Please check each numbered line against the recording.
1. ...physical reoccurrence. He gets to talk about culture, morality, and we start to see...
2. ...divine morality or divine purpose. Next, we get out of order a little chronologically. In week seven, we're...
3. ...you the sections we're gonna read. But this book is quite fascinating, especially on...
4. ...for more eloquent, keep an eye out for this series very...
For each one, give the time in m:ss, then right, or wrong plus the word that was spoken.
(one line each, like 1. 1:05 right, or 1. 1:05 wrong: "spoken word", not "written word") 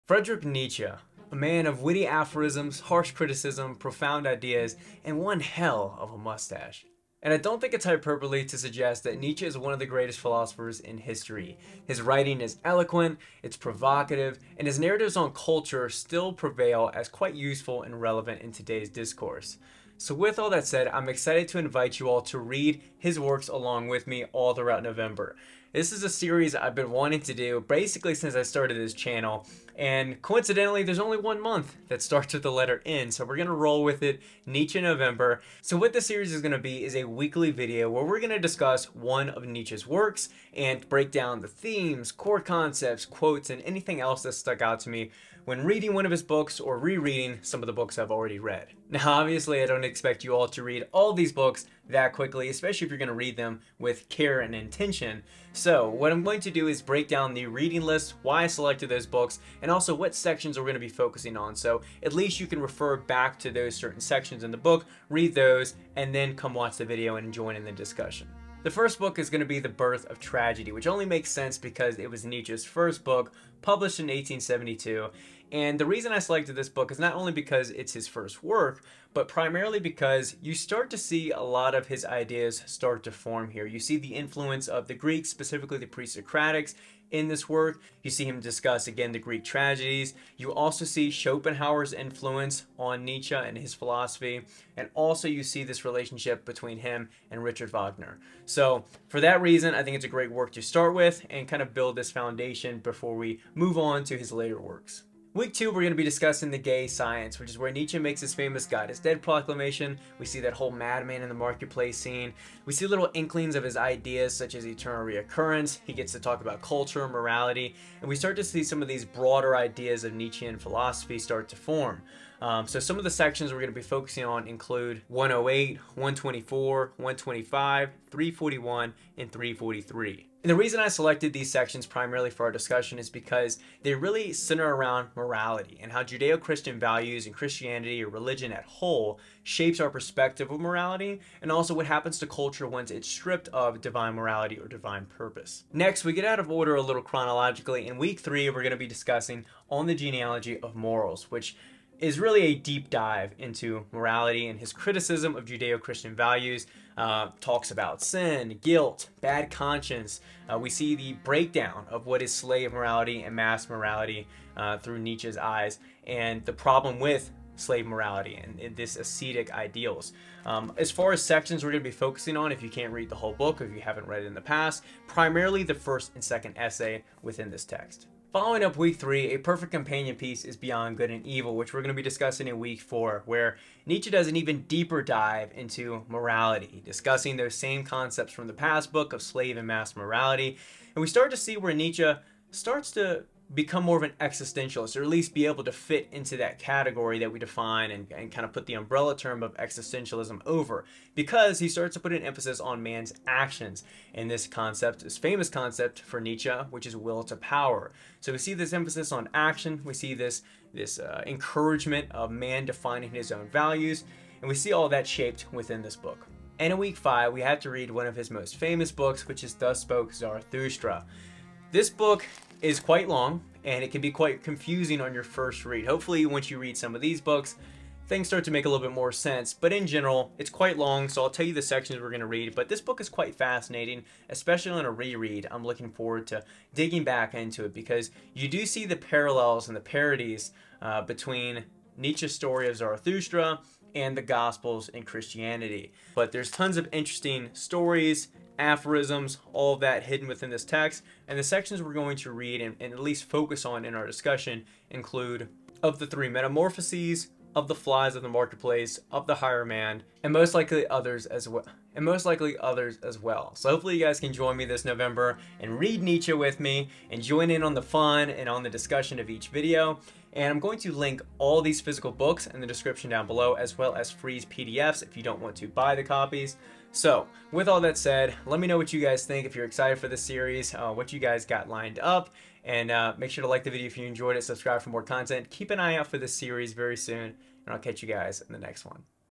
1. 1:54 wrong: "eternal", not "physical"
2. 2:23 wrong: "three", not "seven"
3. 3:51 right
4. 4:44 wrong: "content", not "eloquent".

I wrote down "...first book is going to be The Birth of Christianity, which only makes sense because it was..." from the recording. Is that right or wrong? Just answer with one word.
wrong.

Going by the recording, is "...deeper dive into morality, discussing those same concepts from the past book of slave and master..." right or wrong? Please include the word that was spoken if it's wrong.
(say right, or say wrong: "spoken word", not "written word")
right.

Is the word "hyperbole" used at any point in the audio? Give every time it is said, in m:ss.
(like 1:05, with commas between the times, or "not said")
0:07.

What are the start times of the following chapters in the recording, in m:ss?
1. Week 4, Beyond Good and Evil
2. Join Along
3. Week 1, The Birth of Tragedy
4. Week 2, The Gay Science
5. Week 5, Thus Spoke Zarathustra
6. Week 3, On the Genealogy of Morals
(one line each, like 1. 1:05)
1. 2:58
2. 4:20
3. 1:08
4. 1:45
5. 3:36
6. 2:25.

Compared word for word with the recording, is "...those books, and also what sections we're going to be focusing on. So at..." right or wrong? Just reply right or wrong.
right.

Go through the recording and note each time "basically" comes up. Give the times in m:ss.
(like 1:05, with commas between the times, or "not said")
0:27.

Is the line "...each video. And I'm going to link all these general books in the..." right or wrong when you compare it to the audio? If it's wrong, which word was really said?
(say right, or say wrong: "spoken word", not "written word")
wrong: "physical", not "general".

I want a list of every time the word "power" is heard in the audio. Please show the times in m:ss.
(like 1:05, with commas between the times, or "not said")
3:27.